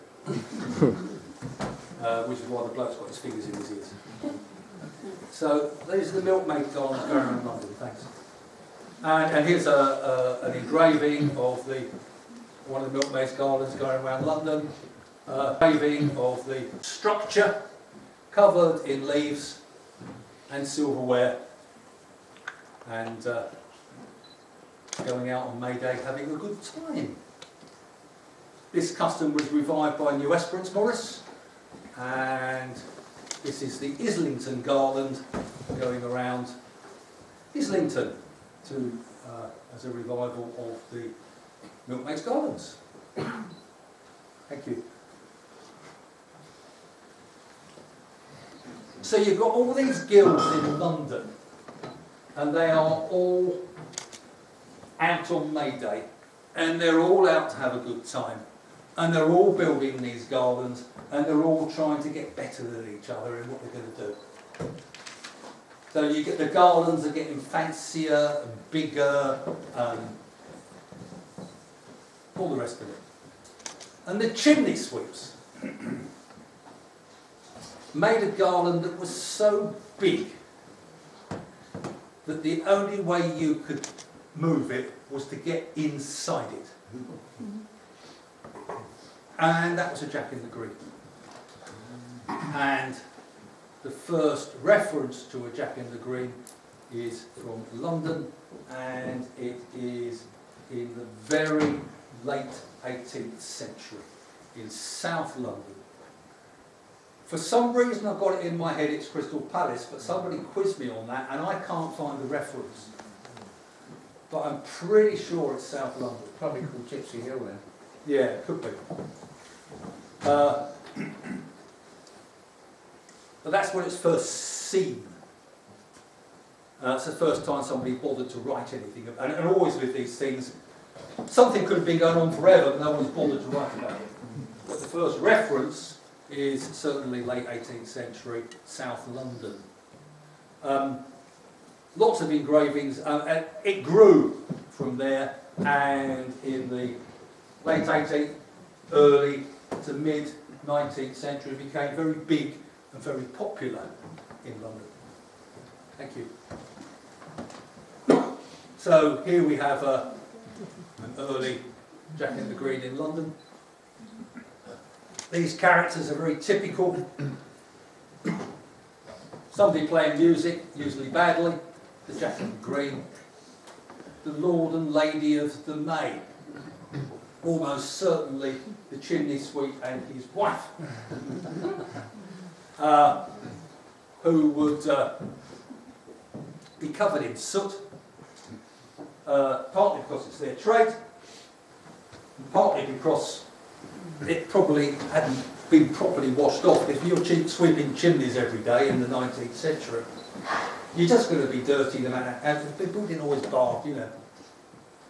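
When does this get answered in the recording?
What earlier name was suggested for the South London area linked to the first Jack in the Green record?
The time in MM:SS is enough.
01:56.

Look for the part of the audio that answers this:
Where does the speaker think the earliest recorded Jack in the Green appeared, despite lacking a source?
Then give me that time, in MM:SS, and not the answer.
01:49.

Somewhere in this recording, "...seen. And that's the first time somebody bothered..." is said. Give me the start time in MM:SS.
02:04.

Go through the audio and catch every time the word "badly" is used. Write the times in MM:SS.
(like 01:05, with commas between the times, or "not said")
02:51.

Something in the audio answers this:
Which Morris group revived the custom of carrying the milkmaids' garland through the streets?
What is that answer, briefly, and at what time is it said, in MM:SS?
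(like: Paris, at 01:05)
New Esperance Morris, at 00:30.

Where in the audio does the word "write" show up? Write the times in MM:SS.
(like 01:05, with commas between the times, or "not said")
02:08, 02:13.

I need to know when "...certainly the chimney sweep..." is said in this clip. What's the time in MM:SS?
02:57.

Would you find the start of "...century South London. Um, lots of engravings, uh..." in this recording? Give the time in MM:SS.
02:17.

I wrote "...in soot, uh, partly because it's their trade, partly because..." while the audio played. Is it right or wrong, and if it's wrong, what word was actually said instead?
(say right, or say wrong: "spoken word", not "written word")
right.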